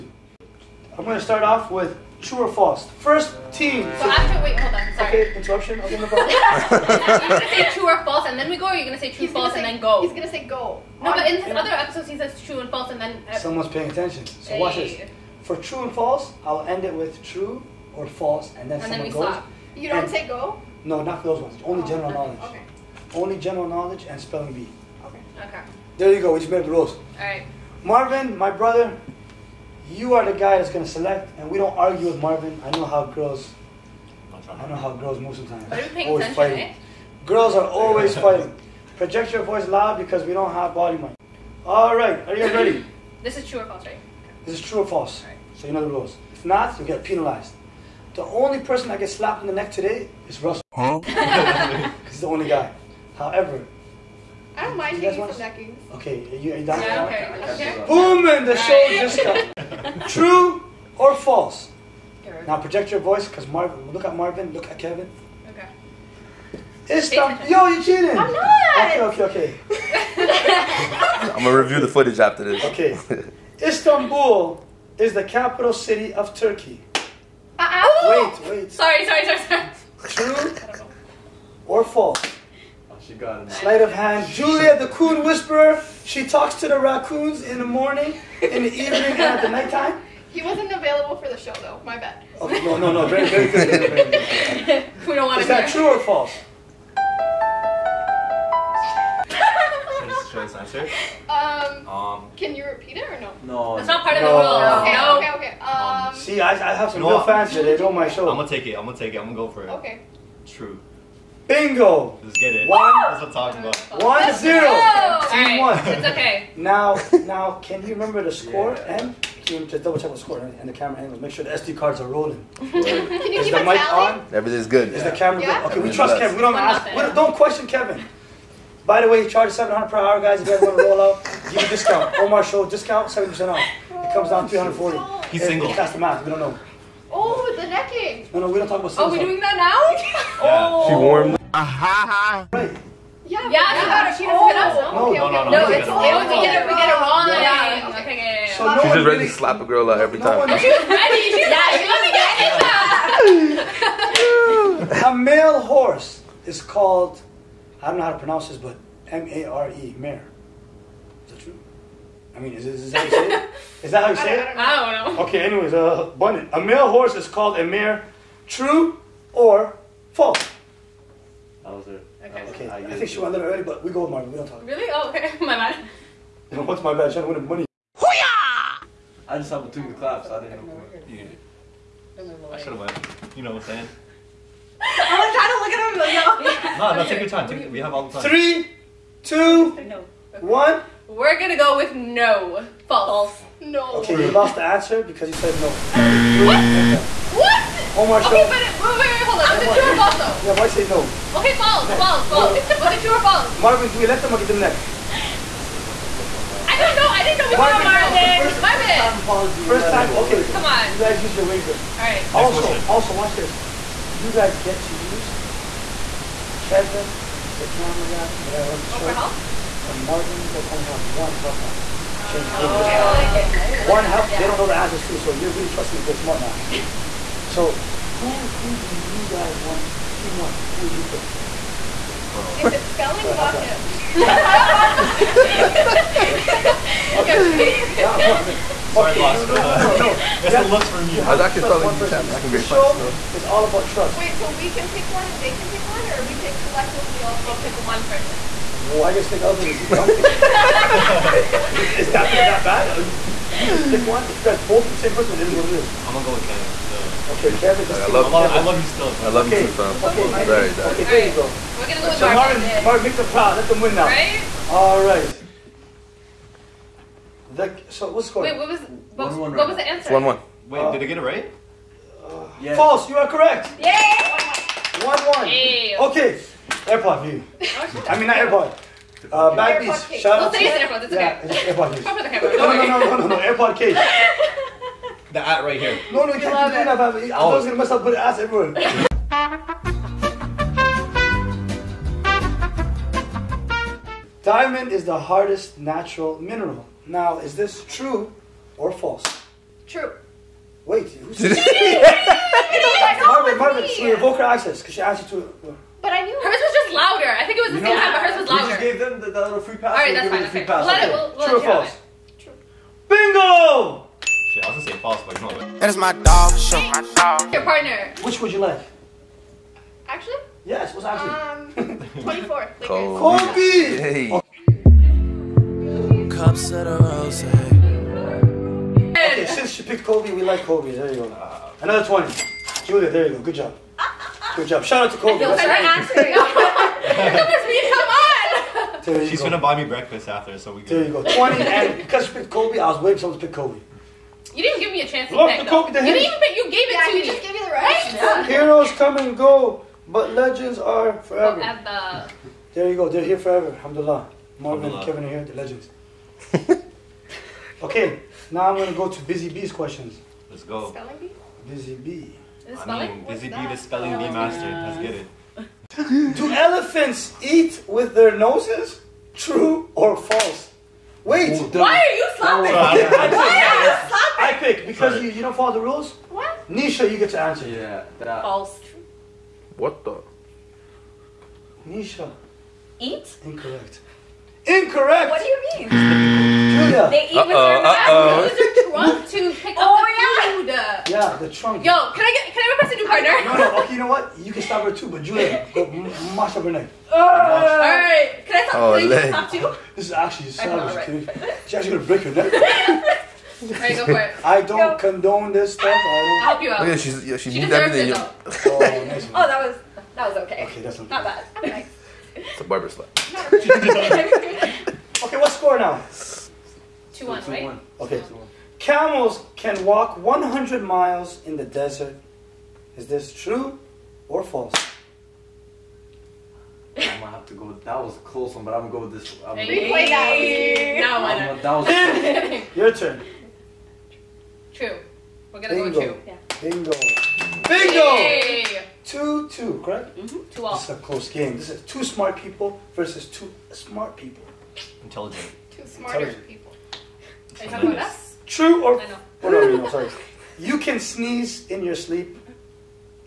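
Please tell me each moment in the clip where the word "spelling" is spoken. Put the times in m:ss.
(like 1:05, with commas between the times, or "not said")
0:24, 3:52, 4:01, 6:03.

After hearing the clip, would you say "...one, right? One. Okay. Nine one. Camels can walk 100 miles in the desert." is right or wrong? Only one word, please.
wrong.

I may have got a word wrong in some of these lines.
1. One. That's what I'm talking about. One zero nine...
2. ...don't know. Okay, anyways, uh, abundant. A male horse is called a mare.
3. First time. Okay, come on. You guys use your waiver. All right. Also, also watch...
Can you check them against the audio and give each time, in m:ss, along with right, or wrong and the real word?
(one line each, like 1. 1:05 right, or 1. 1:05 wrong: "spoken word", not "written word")
1. 1:52 wrong: "two", not "nine"
2. 2:45 right
3. 3:29 right.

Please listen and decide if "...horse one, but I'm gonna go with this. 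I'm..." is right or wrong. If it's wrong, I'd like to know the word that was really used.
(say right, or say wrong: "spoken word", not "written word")
wrong: "close", not "horse".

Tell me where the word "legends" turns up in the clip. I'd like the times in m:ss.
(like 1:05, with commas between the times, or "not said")
5:50, 5:55.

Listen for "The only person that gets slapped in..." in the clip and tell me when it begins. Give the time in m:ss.
0:48.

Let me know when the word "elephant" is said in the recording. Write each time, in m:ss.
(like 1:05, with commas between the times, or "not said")
4:09, 6:06.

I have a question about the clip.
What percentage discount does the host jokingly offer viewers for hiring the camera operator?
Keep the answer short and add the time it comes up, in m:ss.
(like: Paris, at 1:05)
70%, at 2:13.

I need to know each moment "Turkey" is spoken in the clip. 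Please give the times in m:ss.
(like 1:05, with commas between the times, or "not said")
1:16.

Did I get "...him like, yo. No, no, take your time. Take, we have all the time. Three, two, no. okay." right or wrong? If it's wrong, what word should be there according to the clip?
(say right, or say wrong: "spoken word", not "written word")
right.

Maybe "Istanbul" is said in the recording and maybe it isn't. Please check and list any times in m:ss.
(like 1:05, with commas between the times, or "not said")
1:06, 1:13.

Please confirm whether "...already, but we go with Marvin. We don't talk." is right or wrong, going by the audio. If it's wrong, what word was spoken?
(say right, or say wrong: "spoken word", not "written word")
right.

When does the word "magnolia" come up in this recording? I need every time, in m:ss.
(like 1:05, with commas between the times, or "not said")
not said.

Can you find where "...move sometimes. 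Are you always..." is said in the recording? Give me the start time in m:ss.
0:35.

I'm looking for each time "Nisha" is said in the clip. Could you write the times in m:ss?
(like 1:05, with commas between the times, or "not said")
6:16, 6:21.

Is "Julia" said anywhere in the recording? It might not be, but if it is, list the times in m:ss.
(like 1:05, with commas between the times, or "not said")
1:24, 5:32, 6:35.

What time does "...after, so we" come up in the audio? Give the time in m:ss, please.
5:40.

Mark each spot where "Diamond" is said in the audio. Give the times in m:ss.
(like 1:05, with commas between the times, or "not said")
4:54.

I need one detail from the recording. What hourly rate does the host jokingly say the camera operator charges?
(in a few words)
700.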